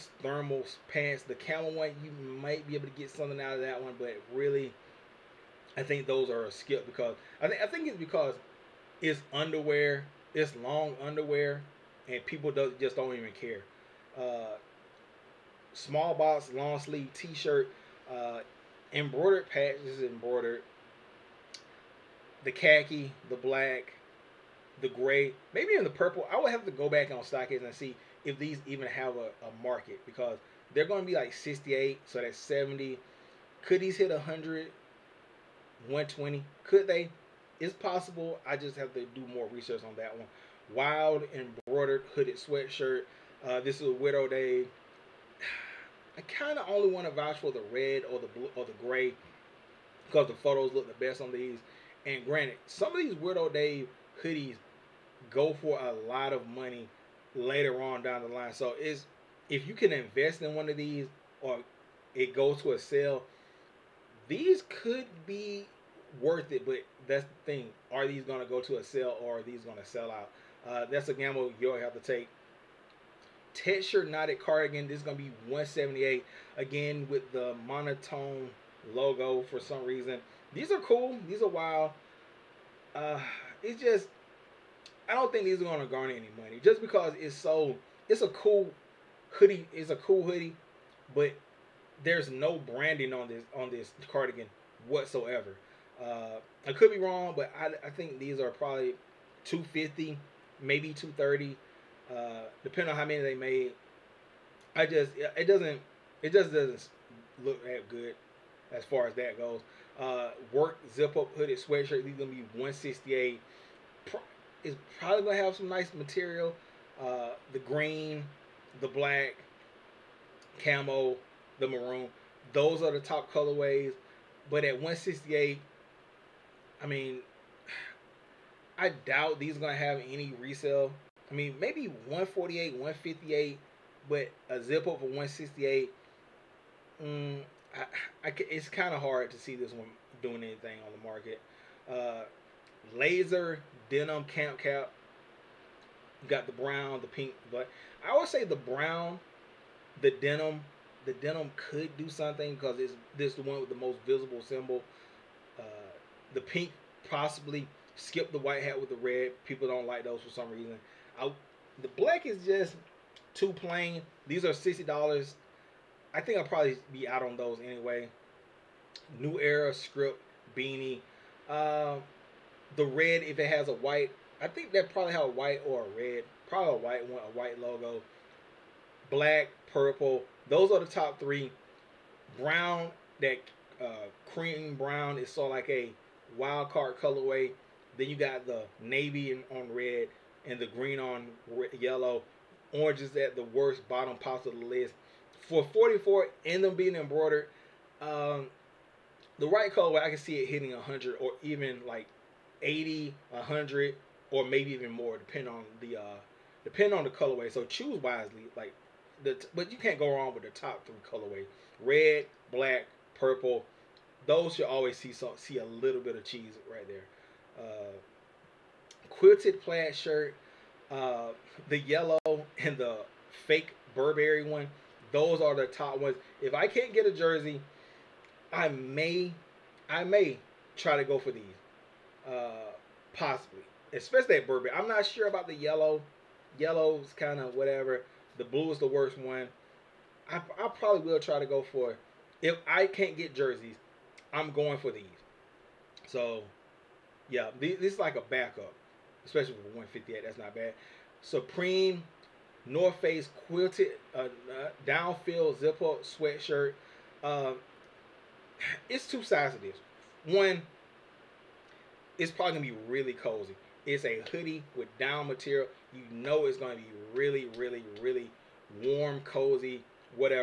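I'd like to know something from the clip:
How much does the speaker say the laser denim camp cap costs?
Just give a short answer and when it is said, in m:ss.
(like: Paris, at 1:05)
60 dollars, at 2:44.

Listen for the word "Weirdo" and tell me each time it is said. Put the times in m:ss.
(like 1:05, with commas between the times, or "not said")
0:43, 0:53.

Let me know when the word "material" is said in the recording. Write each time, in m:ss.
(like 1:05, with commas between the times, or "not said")
1:55, 4:25.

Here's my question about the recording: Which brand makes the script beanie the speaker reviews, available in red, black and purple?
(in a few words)
New Era.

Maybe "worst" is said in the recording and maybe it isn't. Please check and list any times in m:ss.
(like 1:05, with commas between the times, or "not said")
3:13, 3:58.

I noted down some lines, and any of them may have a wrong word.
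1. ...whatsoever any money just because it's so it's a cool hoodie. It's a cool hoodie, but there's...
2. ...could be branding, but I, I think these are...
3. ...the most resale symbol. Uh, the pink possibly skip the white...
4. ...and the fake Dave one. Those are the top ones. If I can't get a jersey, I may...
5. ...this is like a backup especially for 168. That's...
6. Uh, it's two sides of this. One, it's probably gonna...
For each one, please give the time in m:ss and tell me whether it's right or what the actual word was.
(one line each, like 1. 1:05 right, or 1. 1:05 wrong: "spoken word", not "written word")
1. 1:25 wrong: "garner", not "whatsoever"
2. 1:36 wrong: "wrong", not "branding"
3. 2:33 wrong: "visible", not "resale"
4. 3:42 wrong: "Burberry", not "Dave"
5. 4:07 wrong: "158", not "168"
6. 4:17 right.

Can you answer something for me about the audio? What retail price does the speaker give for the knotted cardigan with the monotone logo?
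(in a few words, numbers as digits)
178.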